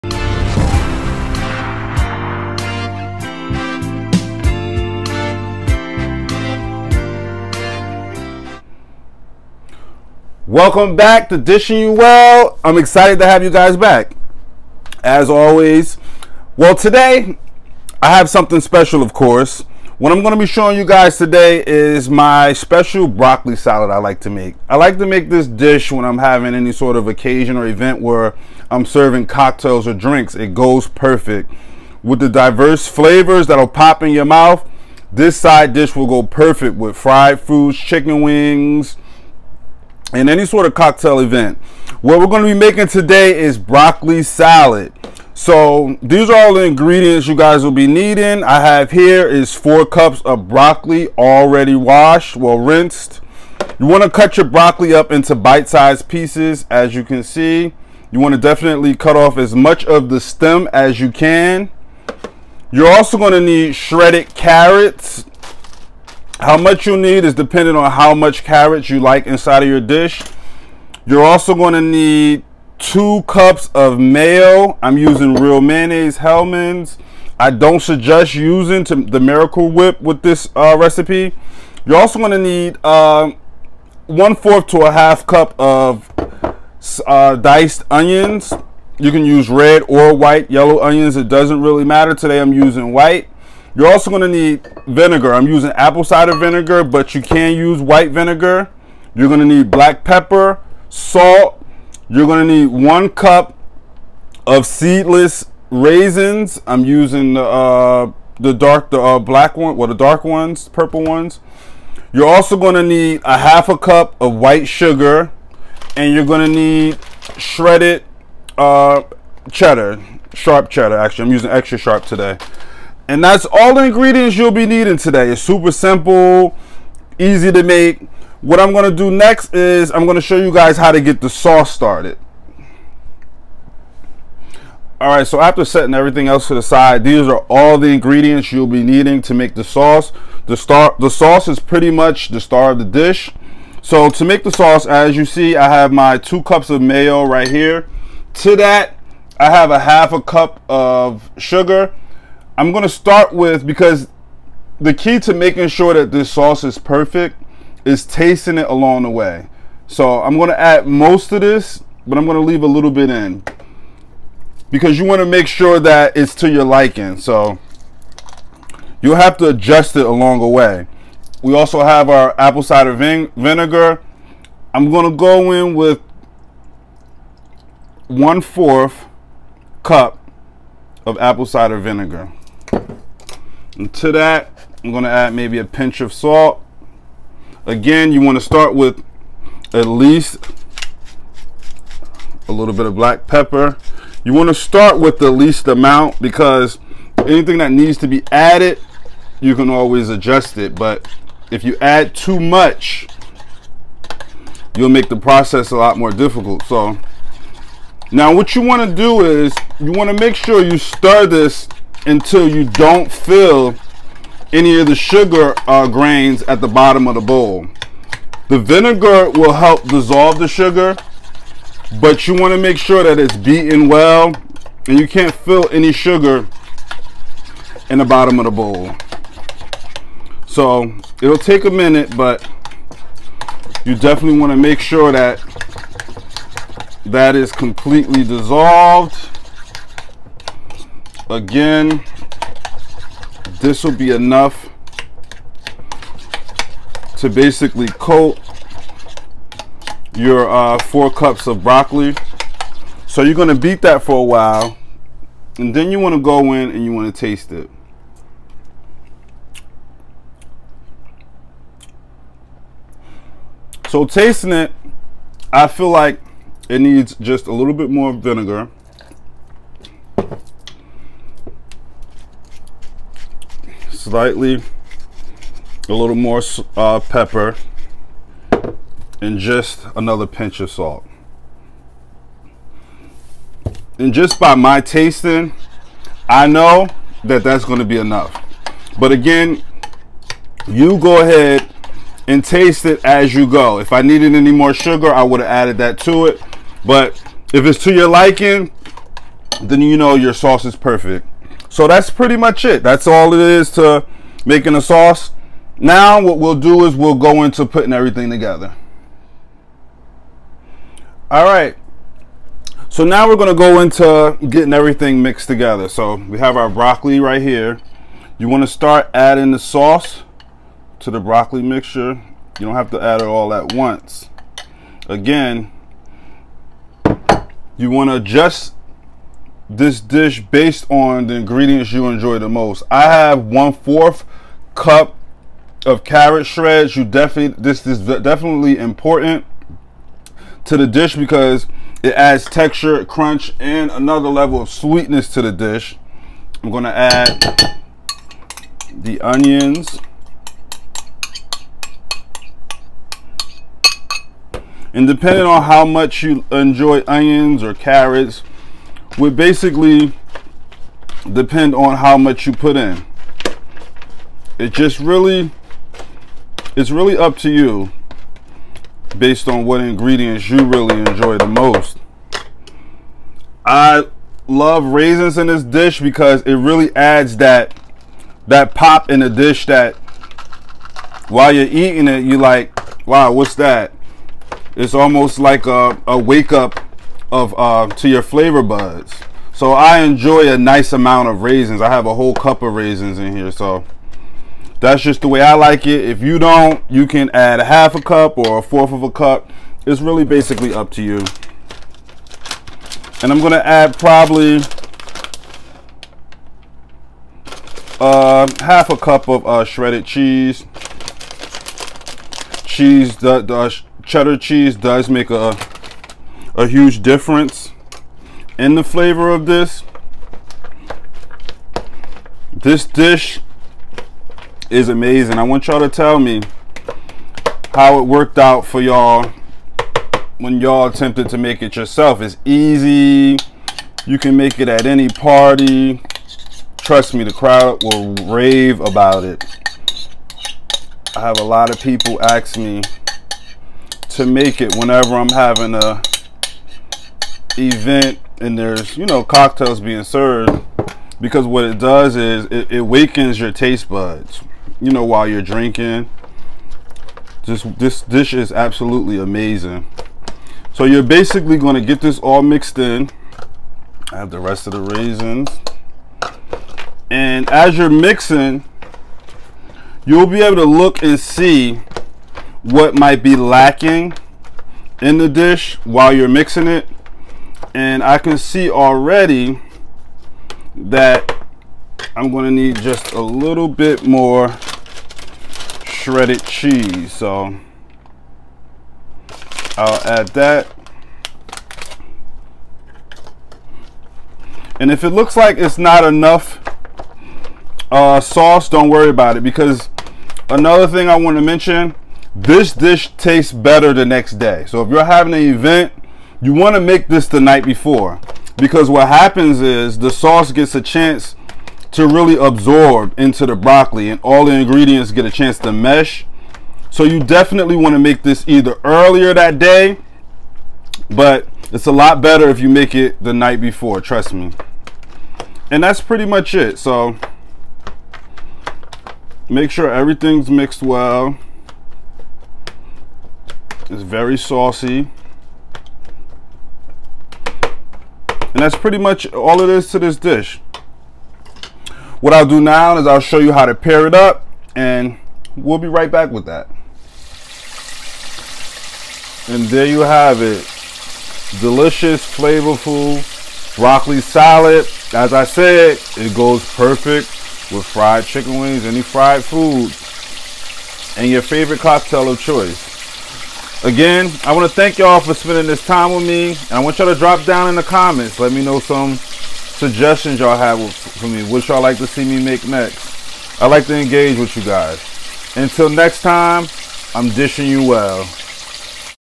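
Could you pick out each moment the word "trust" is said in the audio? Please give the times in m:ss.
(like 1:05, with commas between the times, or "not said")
7:16, 8:44.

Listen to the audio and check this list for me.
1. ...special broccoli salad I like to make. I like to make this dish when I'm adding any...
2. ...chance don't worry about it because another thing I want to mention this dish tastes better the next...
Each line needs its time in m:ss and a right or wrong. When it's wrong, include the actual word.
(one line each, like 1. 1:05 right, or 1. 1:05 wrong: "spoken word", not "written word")
1. 0:22 wrong: "having", not "adding"
2. 8:18 wrong: "sauce", not "chance".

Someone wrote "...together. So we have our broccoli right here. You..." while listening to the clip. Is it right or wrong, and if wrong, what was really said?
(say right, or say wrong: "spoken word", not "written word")
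right.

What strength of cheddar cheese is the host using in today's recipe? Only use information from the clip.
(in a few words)
extra sharp.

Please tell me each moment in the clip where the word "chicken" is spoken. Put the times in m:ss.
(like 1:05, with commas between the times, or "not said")
0:37, 9:18.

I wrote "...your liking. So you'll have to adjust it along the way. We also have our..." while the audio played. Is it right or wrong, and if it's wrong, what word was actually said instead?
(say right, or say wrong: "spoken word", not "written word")
right.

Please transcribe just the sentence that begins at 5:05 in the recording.
Now what we'll do is we'll go into putting everything together.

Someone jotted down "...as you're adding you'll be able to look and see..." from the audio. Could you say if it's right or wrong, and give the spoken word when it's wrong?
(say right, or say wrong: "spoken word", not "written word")
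wrong: "mixing", not "adding".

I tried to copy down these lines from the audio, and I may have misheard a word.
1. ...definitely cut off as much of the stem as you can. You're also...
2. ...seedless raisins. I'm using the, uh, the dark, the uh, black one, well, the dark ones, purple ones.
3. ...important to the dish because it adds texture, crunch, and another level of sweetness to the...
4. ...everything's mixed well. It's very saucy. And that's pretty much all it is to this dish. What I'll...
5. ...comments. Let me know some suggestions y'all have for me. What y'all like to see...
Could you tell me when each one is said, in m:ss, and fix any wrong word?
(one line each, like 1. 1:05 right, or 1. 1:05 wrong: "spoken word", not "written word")
1. 0:58 right
2. 1:44 right
3. 5:38 right
4. 8:49 right
5. 9:27 right.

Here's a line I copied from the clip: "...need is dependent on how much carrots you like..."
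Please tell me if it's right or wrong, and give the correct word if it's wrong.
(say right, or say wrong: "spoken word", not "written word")
right.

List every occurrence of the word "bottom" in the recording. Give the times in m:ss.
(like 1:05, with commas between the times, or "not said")
3:36, 3:48.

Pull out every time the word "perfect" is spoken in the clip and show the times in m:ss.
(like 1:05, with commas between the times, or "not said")
0:30, 0:36, 2:36, 5:00, 9:16.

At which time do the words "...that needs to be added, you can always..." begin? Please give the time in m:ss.
3:17.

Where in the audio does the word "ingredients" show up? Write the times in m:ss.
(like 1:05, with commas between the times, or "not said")
0:46, 2:03, 2:17, 5:31, 6:09, 8:34.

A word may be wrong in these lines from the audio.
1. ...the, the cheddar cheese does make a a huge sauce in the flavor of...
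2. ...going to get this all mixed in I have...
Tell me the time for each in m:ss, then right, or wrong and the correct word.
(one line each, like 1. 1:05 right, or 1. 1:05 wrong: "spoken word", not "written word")
1. 6:53 wrong: "difference", not "sauce"
2. 7:41 right.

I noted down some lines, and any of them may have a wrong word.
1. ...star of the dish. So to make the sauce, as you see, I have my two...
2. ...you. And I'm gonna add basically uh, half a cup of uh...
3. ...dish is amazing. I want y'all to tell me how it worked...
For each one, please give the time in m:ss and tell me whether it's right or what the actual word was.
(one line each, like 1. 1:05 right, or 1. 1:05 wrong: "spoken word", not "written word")
1. 2:22 right
2. 6:41 wrong: "probably", not "basically"
3. 7:02 right.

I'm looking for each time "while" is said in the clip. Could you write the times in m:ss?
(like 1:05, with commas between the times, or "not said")
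4:14, 6:21, 7:35, 7:55.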